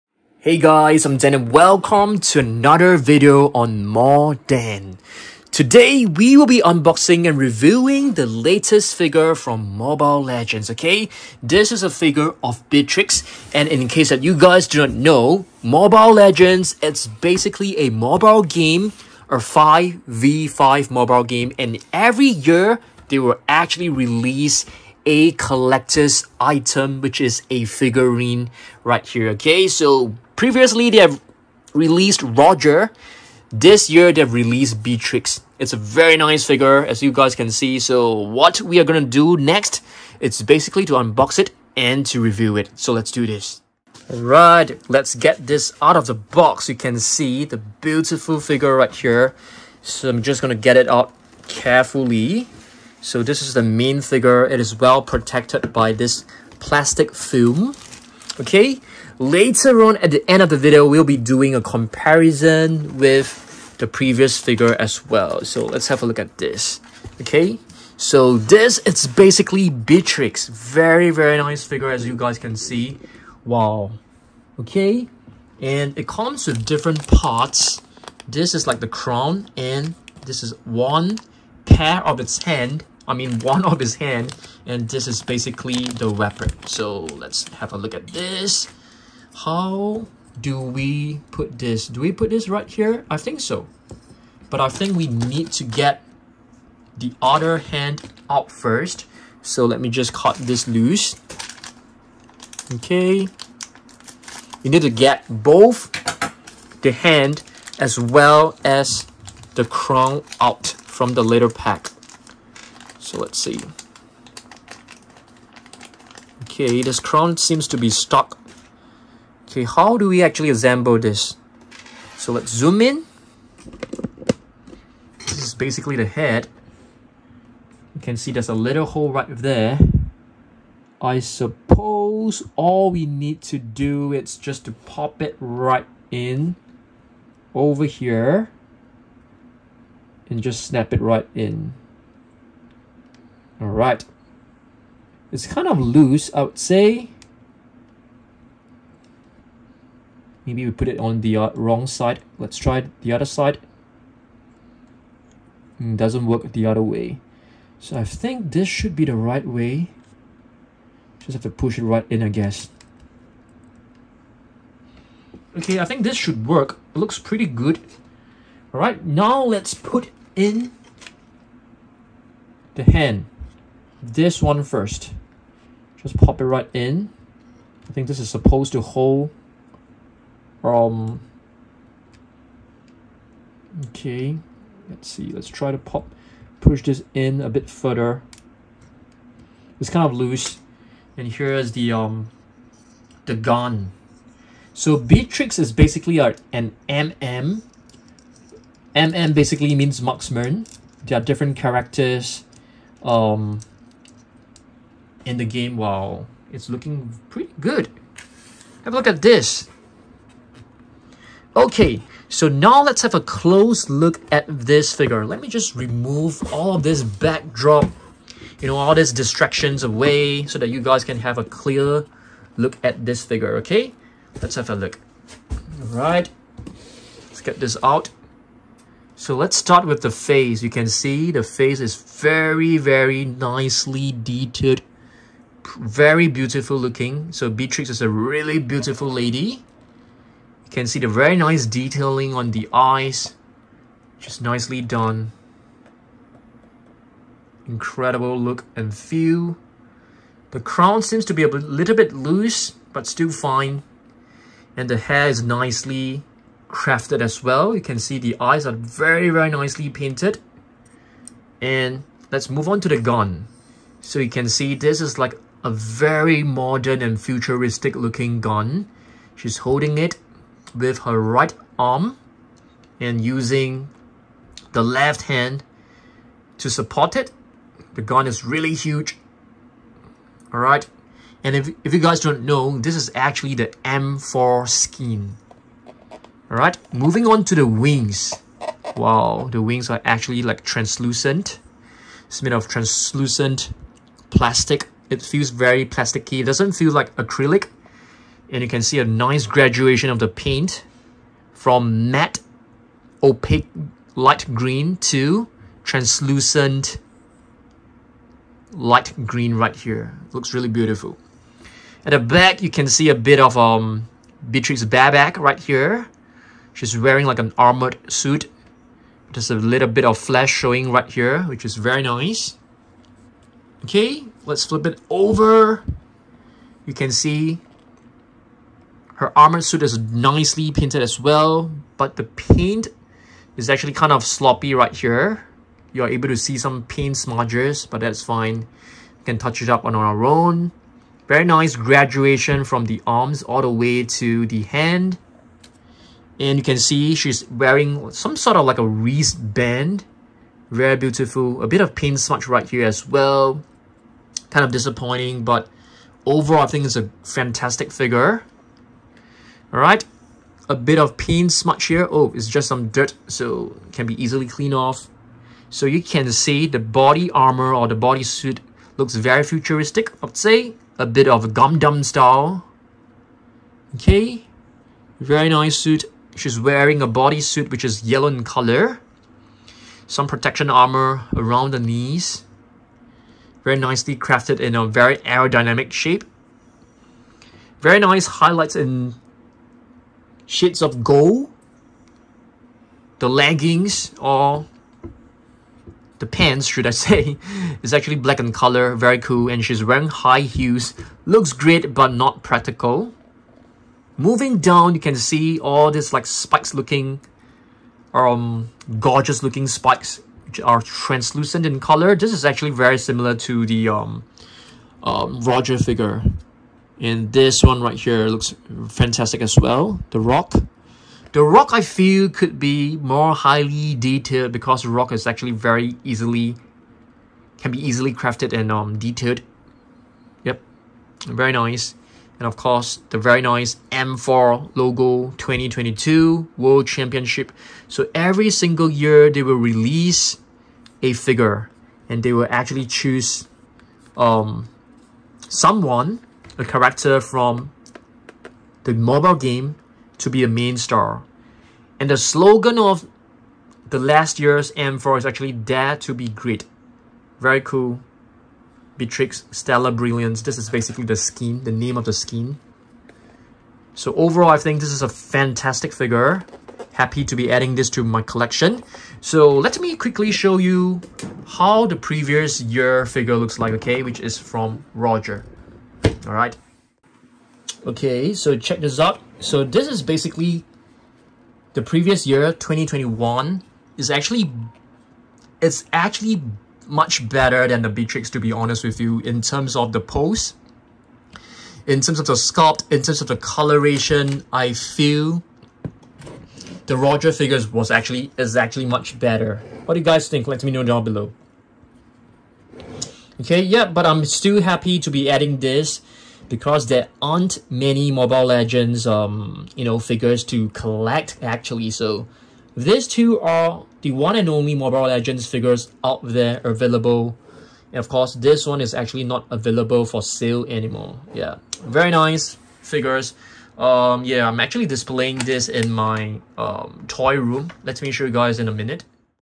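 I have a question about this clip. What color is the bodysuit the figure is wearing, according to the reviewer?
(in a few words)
Yellow.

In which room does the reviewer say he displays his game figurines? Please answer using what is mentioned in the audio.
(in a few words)
Toy room.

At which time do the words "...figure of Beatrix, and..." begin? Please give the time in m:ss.
0:11.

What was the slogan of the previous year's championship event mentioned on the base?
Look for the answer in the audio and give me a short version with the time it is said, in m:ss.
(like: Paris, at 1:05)
Dare to be Great, at 7:35.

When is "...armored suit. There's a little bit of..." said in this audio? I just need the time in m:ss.
5:17.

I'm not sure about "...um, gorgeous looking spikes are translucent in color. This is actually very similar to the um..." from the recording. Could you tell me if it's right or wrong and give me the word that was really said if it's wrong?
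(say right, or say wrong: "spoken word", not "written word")
right.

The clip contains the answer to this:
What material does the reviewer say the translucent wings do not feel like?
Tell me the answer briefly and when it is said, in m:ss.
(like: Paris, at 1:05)
Acrylic, at 4:57.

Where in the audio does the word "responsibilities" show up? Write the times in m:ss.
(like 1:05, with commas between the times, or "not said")
not said.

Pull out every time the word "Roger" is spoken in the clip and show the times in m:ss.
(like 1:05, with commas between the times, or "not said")
0:32, 6:55, 7:54, 8:16.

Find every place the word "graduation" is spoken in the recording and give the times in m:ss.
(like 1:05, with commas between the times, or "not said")
4:59, 5:41.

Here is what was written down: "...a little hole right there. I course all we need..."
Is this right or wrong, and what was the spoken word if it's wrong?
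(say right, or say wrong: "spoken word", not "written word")
wrong: "suppose", not "course".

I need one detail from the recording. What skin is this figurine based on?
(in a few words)
Stellar Brilliance.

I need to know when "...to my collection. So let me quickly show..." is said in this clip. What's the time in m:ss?
7:47.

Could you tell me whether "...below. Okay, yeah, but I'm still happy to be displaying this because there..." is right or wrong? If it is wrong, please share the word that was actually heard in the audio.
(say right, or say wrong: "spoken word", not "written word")
wrong: "adding", not "displaying".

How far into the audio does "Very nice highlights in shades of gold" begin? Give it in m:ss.
6:27.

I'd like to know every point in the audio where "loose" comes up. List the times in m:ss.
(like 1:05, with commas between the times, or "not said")
1:40, 2:25, 3:10, 4:12.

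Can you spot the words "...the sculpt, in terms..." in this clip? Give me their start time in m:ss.
8:12.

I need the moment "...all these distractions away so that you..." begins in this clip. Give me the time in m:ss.
3:38.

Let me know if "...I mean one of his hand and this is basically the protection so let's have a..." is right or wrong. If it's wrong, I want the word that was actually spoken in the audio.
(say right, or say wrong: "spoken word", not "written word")
wrong: "weapon", not "protection".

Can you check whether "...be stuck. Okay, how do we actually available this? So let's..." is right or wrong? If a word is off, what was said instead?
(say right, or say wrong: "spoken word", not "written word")
wrong: "assemble", not "available".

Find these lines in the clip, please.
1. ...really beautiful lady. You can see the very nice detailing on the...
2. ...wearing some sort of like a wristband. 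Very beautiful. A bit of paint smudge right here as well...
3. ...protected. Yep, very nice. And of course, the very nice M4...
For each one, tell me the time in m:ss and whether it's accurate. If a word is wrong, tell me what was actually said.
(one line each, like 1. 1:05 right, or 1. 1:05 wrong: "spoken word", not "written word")
1. 3:58 right
2. 5:47 right
3. 7:08 wrong: "detailed", not "protected".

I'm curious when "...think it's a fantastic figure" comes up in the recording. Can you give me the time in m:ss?
5:56.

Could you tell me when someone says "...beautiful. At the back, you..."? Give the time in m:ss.
5:10.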